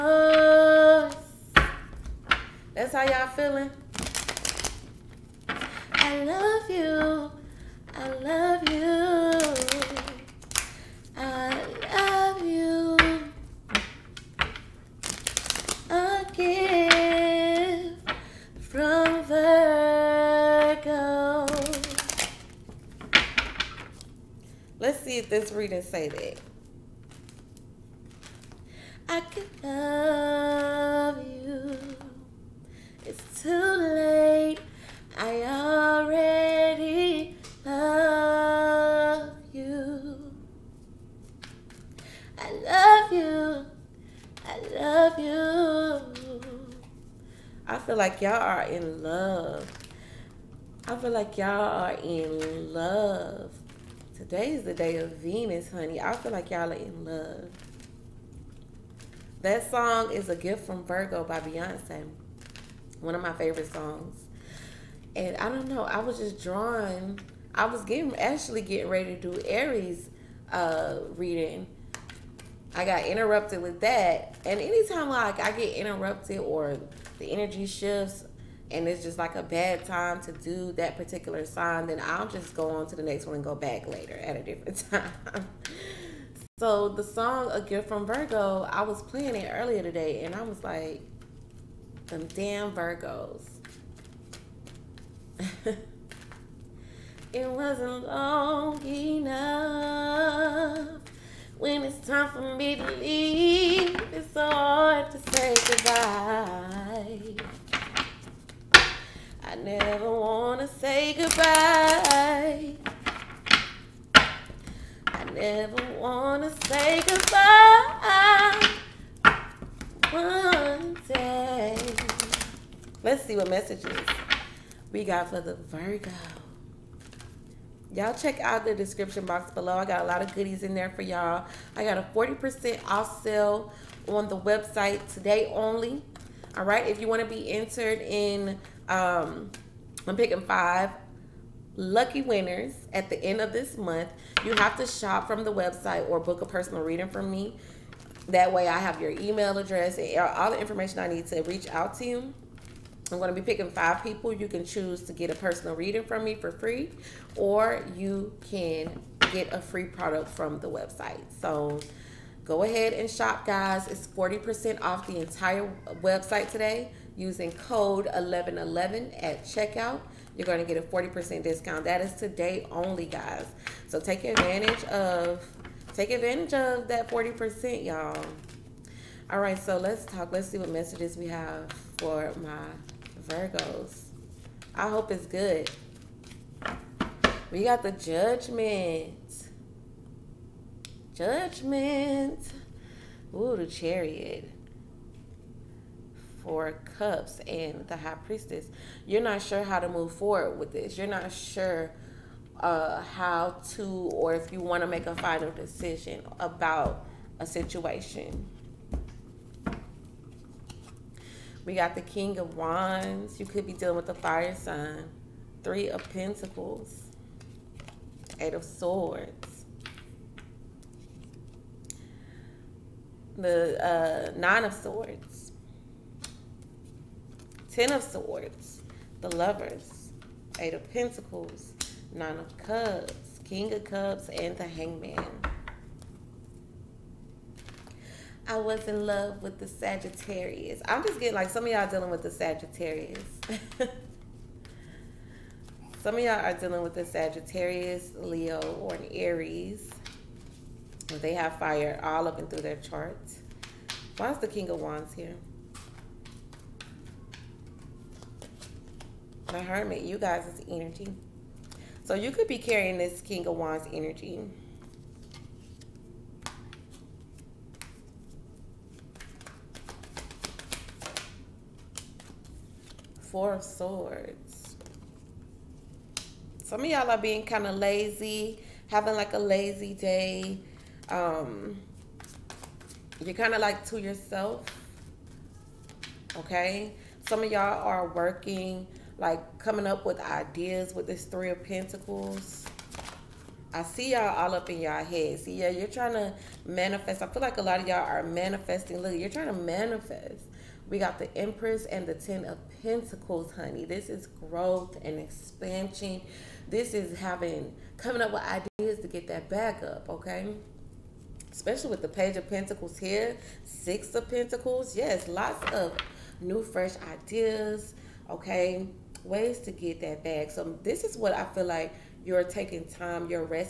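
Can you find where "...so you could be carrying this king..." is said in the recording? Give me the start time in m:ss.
4:22.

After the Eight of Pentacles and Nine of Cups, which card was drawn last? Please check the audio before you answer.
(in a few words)
The Hangman.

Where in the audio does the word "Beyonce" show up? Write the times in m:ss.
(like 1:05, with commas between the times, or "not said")
1:01.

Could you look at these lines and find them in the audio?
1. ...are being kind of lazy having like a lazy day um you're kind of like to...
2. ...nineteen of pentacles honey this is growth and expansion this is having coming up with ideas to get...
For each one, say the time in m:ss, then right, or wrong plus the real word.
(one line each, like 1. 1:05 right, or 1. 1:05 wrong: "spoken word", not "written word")
1. 4:37 right
2. 5:02 wrong: "ten", not "nineteen".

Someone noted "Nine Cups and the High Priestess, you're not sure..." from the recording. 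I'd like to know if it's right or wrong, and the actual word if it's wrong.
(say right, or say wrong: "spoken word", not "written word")
wrong: "Four", not "Nine".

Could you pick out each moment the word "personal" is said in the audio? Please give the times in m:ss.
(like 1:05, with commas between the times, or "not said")
2:26, 2:35.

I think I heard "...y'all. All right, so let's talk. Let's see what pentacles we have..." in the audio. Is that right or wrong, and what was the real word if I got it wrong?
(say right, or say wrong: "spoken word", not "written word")
wrong: "messages", not "pentacles".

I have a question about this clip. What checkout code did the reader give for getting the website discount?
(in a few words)
1111.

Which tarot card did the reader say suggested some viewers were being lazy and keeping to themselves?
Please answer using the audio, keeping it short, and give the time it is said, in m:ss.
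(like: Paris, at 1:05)
Four of Swords, at 4:33.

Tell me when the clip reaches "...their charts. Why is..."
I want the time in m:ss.
4:12.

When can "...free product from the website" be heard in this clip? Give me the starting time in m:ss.
2:39.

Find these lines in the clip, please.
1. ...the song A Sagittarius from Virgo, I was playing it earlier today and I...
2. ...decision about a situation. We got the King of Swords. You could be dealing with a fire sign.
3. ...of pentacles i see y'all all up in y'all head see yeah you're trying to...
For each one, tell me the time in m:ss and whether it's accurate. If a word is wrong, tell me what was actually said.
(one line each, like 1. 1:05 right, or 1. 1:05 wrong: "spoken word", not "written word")
1. 1:26 wrong: "Gift", not "Sagittarius"
2. 3:25 wrong: "Wands", not "Swords"
3. 4:51 right.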